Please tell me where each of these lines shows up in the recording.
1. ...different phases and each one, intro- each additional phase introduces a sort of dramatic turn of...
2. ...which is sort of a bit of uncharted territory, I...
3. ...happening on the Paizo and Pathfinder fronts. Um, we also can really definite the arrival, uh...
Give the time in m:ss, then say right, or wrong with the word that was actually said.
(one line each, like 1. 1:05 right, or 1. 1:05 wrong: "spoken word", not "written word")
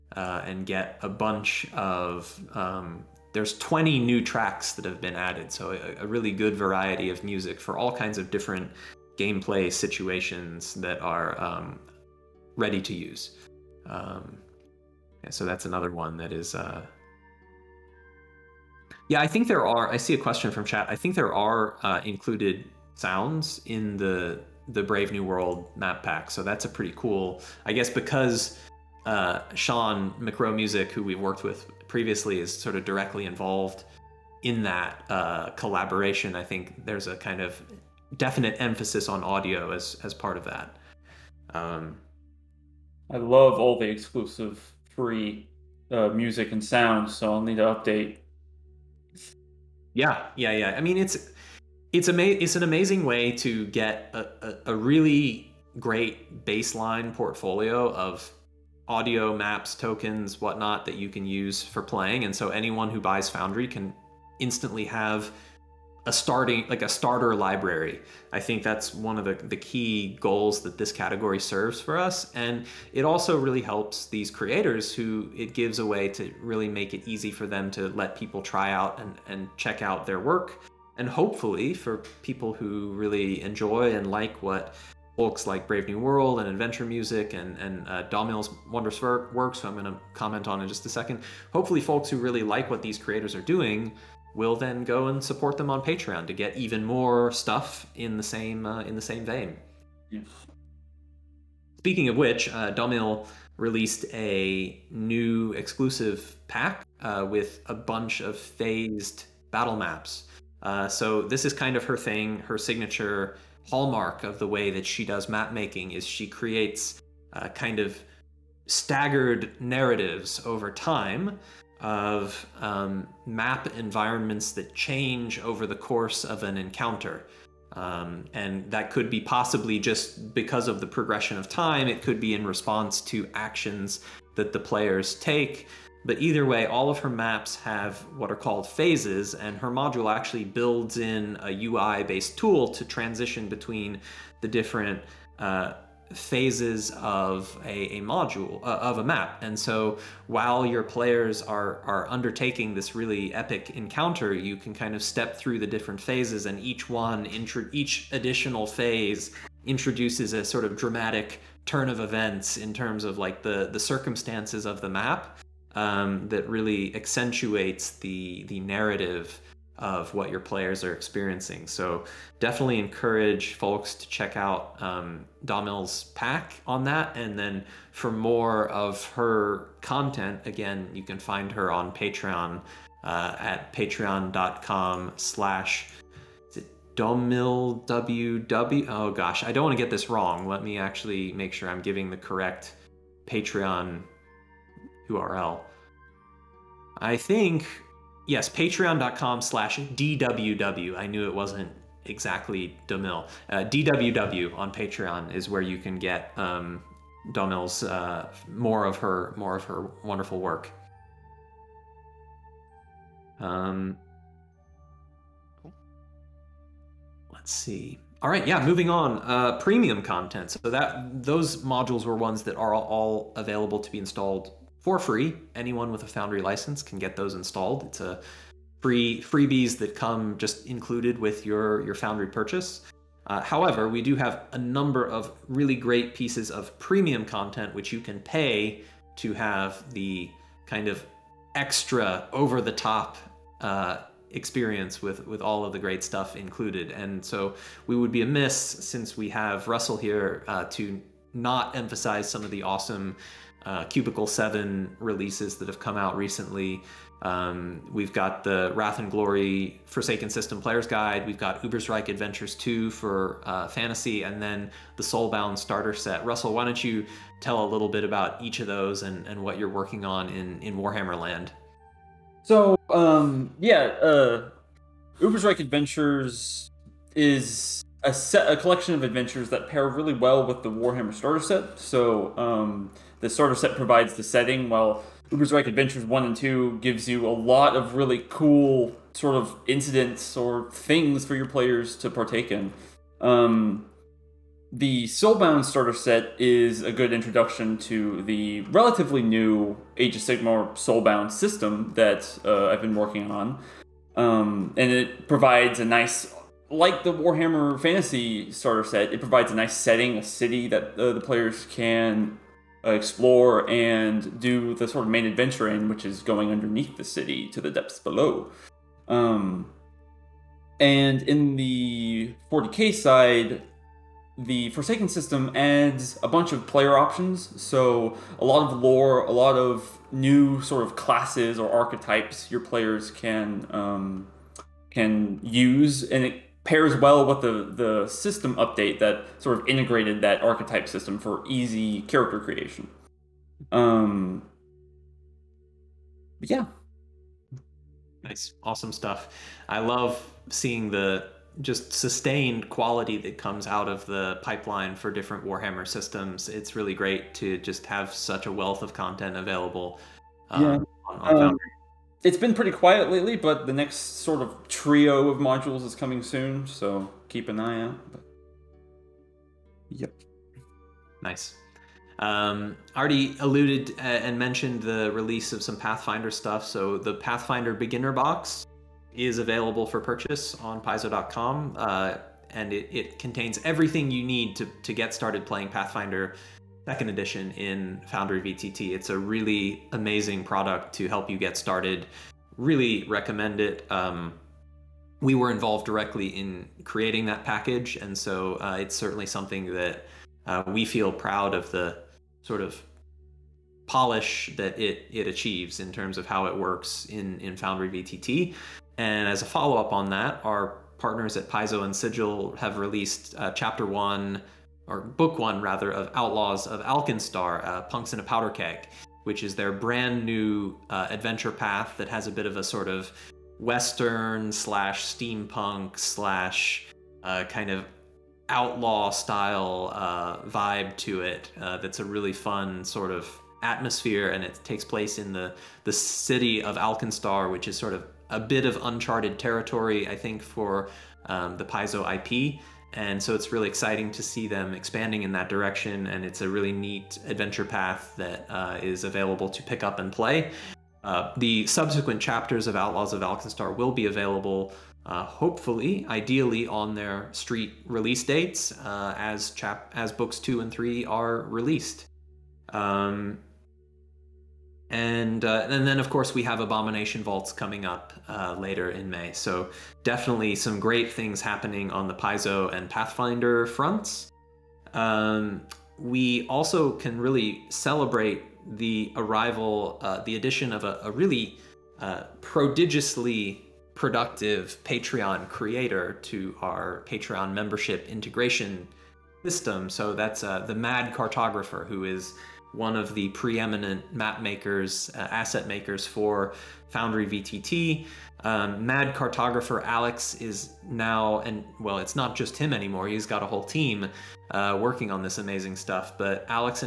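1. 2:35 right
2. 7:17 right
3. 7:51 wrong: "celebrate", not "definite".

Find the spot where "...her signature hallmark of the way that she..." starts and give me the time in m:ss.
1:52.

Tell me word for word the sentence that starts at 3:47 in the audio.
It's a free freebies that come just included with your your Foundry purchase.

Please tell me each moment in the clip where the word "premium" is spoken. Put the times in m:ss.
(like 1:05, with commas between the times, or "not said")
3:39, 3:56.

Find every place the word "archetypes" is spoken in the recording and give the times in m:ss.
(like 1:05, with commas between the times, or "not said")
5:31, 5:40.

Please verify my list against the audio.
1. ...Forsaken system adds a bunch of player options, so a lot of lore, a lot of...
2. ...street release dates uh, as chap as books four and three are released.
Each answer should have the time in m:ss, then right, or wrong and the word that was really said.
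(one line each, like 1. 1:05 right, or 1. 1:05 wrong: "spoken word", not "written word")
1. 5:24 right
2. 7:37 wrong: "two", not "four".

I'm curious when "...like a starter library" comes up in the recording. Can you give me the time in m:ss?
1:06.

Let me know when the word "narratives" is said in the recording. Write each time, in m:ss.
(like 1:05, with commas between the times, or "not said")
1:59, 2:48.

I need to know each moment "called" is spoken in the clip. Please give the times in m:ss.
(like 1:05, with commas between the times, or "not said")
2:18.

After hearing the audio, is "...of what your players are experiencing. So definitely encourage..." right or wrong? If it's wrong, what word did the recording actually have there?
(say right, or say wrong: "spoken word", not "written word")
right.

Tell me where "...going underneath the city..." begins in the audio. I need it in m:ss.
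5:16.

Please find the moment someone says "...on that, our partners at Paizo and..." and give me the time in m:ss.
6:49.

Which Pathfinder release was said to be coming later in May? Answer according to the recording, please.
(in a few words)
Abomination Vaults.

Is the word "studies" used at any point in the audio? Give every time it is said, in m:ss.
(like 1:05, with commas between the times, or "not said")
not said.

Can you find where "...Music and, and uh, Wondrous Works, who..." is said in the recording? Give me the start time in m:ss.
1:26.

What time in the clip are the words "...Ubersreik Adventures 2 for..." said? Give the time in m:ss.
4:21.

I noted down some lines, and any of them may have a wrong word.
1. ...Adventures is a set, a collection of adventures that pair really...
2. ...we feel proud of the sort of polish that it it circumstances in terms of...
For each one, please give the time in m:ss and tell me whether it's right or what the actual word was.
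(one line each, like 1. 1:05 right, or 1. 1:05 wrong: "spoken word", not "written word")
1. 4:35 right
2. 6:40 wrong: "achieves", not "circumstances".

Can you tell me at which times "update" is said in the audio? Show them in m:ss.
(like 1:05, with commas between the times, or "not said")
0:47, 5:38.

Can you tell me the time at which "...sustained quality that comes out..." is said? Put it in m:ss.
5:51.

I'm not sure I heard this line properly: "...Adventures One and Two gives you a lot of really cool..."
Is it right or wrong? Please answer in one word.
right.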